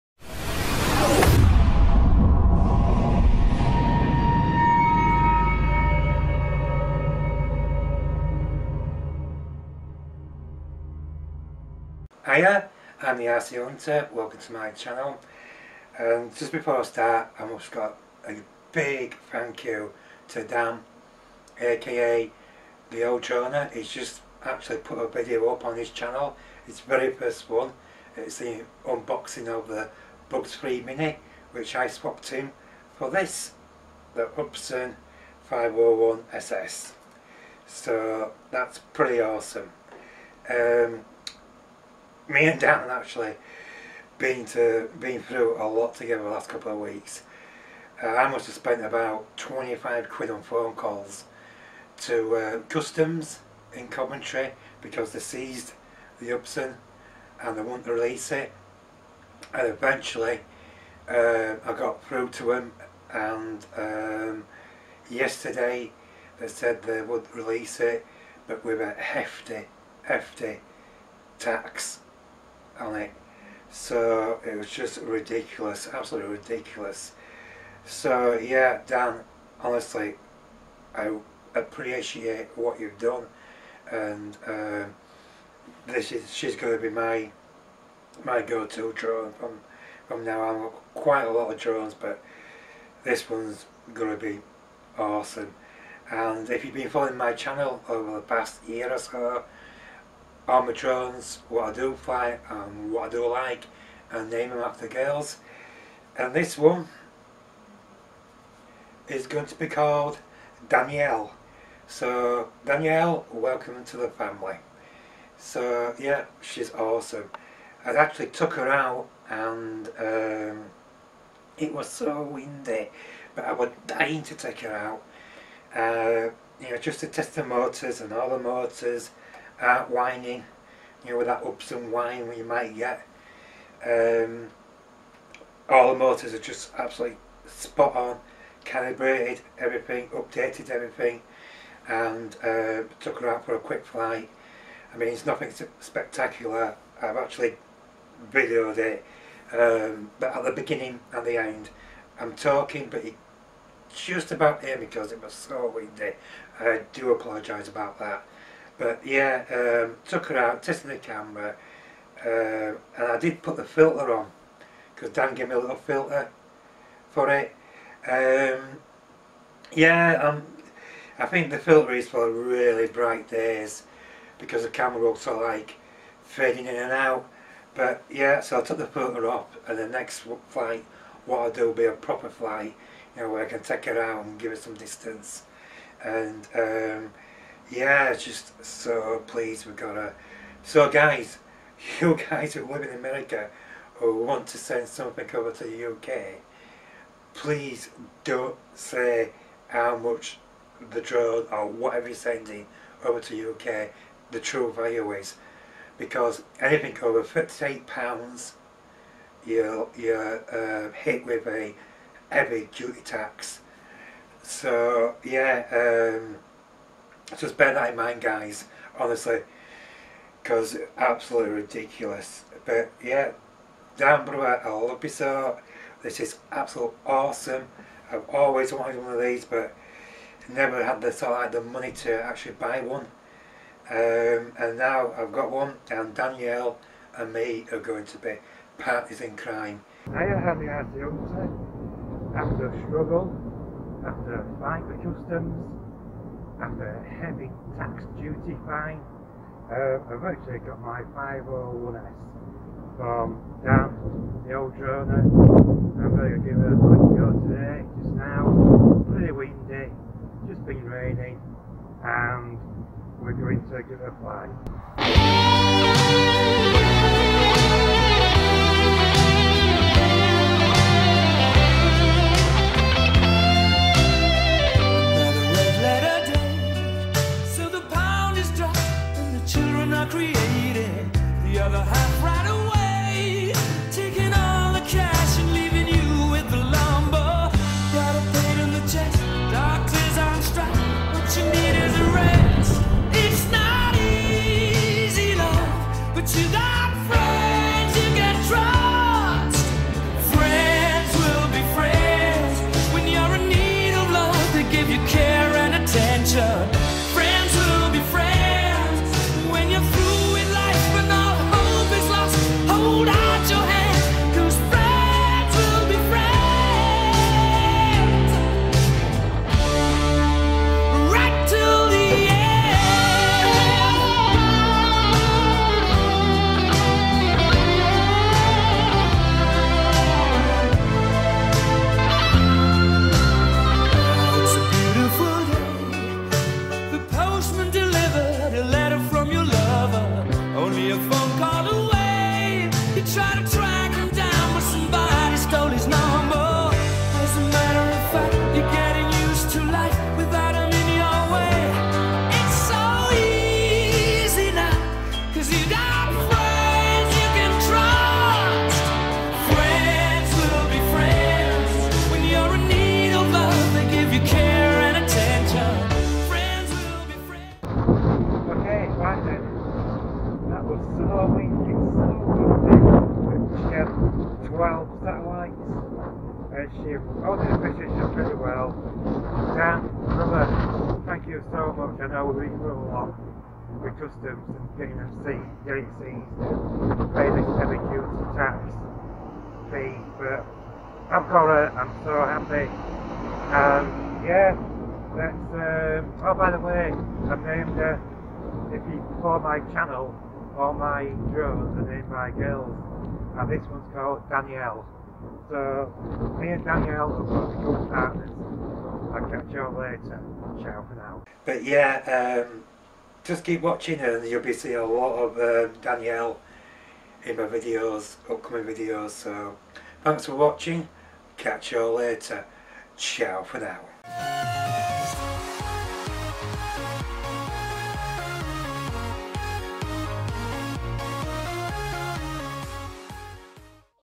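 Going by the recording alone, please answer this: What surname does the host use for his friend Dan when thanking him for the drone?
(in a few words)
Brewer.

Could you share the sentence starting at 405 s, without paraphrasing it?
So me and Danielle are practical partners.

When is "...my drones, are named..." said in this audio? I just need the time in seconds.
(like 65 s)
400 s.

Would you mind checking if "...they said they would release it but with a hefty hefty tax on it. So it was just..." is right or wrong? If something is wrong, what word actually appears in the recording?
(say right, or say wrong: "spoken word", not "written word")
right.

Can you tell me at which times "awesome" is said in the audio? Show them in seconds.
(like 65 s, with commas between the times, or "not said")
39 s, 94 s, 116 s, 227 s.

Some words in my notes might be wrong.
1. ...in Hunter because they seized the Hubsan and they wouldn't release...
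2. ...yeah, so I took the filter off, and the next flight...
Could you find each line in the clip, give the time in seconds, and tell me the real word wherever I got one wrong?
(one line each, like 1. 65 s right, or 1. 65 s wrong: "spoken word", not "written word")
1. 53 s wrong: "Coventry", not "Hunter"
2. 178 s right.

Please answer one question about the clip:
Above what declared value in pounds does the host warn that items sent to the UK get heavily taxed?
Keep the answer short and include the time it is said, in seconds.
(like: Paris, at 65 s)
58 pounds, at 207 s.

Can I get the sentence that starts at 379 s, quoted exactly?
Dan, brother, thank you so much.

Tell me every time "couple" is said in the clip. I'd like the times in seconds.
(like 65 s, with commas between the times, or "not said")
46 s.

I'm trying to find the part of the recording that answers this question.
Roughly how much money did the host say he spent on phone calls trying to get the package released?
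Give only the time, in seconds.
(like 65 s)
49 s.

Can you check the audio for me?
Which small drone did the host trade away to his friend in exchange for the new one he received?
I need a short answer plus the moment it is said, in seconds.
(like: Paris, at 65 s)
Bugs 3 Mini, at 30 s.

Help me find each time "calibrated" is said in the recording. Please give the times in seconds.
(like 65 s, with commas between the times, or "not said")
138 s.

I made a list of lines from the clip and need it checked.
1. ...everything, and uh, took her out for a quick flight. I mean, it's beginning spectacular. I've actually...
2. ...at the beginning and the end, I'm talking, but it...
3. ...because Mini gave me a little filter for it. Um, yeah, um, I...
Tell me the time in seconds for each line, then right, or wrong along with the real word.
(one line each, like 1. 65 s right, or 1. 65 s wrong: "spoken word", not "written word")
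1. 140 s wrong: "nothing", not "beginning"
2. 150 s right
3. 164 s wrong: "Dan", not "Mini".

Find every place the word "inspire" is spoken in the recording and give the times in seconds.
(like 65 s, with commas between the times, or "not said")
not said.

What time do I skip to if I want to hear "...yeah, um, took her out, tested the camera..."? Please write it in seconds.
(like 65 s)
159 s.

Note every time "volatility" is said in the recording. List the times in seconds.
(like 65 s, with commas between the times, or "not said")
not said.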